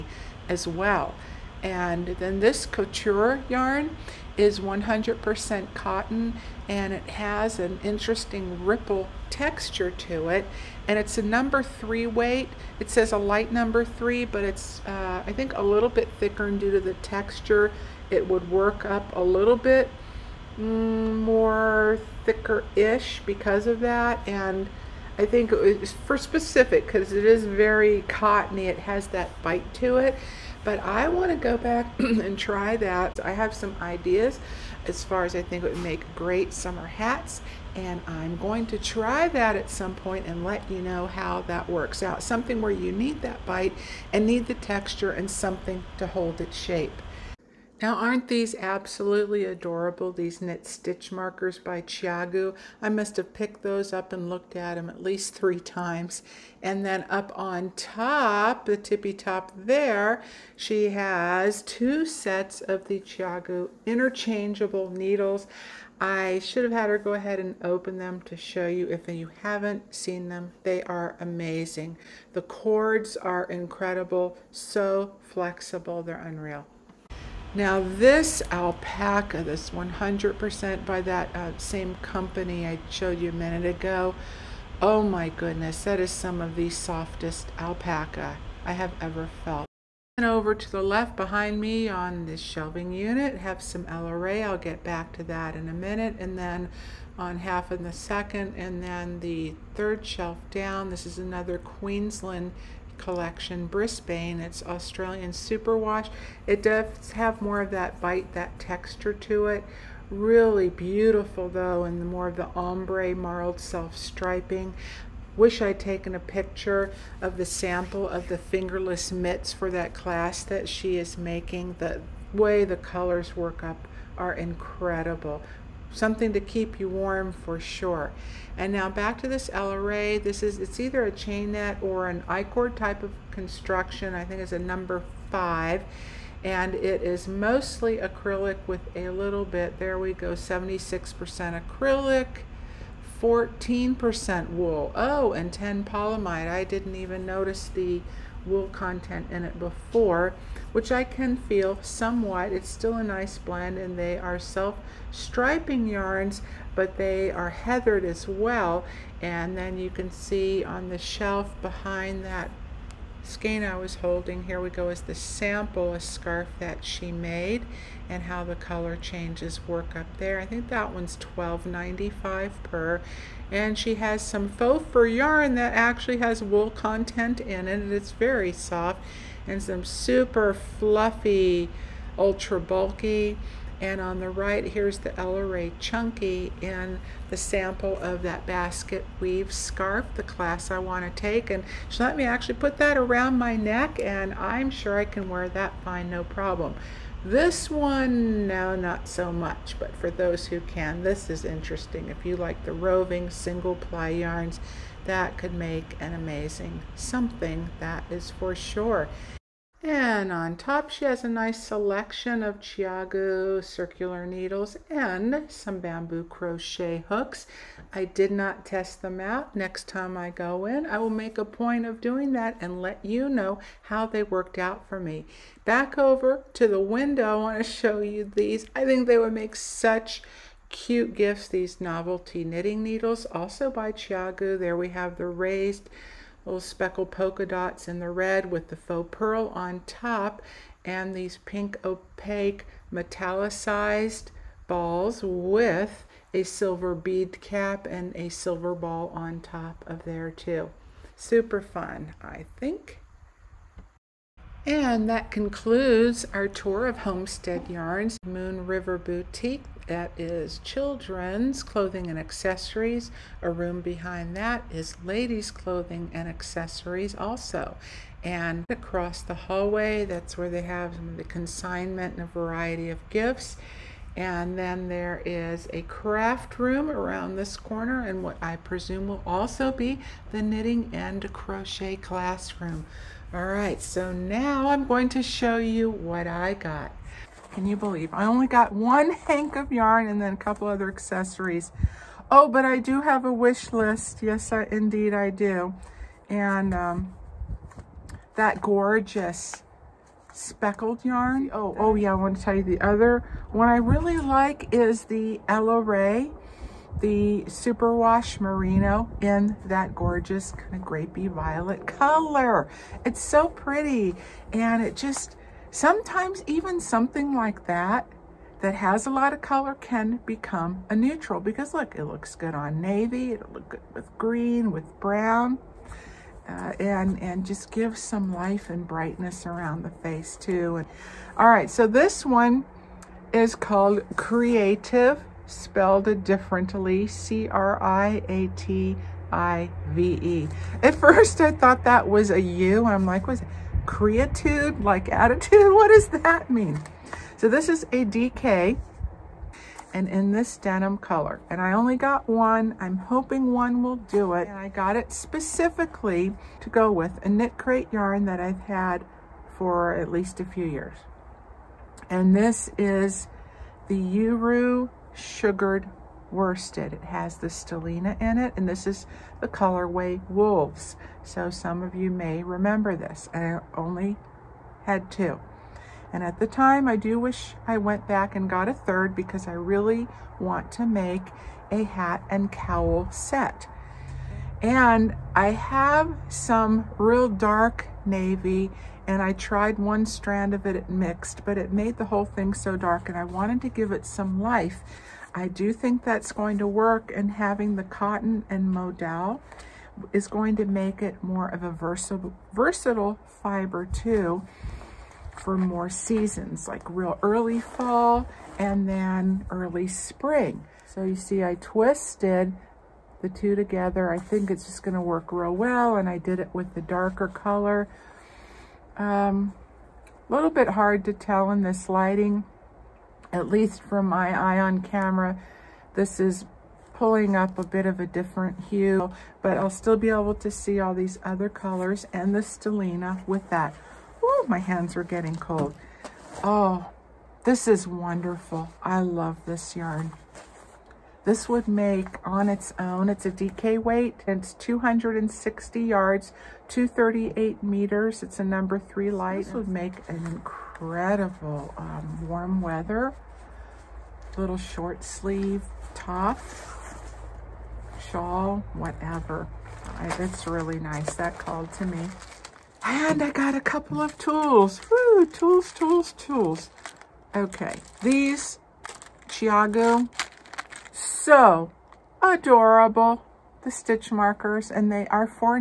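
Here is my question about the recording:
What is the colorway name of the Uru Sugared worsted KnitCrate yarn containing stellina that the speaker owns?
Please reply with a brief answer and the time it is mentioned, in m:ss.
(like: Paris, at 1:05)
Wolves, at 6:10.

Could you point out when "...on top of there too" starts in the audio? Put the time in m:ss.
4:09.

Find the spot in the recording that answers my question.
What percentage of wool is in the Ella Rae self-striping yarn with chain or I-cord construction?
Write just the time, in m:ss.
2:23.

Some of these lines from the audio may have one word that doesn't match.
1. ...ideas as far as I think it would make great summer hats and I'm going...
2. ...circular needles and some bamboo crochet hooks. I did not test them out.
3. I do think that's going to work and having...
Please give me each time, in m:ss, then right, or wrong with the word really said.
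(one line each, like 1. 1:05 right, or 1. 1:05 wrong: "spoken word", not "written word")
1. 0:33 right
2. 3:33 right
3. 6:35 right.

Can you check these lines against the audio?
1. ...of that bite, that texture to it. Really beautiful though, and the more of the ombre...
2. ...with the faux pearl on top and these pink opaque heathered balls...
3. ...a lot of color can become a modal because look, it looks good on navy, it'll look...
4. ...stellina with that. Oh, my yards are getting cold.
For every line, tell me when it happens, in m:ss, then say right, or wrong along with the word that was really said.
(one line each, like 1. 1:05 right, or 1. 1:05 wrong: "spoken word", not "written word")
1. 1:47 right
2. 3:58 wrong: "metallicized", not "heathered"
3. 5:19 wrong: "neutral", not "modal"
4. 7:12 wrong: "hands", not "yards".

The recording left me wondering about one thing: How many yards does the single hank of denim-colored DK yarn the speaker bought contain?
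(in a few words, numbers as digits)
260.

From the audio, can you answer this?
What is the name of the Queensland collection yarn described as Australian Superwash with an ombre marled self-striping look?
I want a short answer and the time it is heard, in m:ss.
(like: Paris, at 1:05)
Brisbane, at 1:43.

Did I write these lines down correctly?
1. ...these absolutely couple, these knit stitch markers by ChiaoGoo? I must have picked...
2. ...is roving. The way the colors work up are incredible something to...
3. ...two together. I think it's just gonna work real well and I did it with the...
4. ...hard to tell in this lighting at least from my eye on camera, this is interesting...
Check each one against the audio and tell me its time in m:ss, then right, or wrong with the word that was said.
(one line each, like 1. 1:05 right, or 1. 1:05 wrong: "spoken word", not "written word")
1. 0:48 wrong: "adorable", not "couple"
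2. 2:00 wrong: "making", not "roving"
3. 6:53 right
4. 7:00 wrong: "pulling", not "interesting".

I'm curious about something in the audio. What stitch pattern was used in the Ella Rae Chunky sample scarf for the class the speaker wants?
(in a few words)
basket weave.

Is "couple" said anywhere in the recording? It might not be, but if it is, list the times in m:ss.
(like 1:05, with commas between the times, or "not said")
4:50, 7:43.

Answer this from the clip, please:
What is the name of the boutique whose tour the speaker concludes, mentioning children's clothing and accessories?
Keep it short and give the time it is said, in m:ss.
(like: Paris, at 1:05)
Homestead Yarns Moon River Boutique, at 4:16.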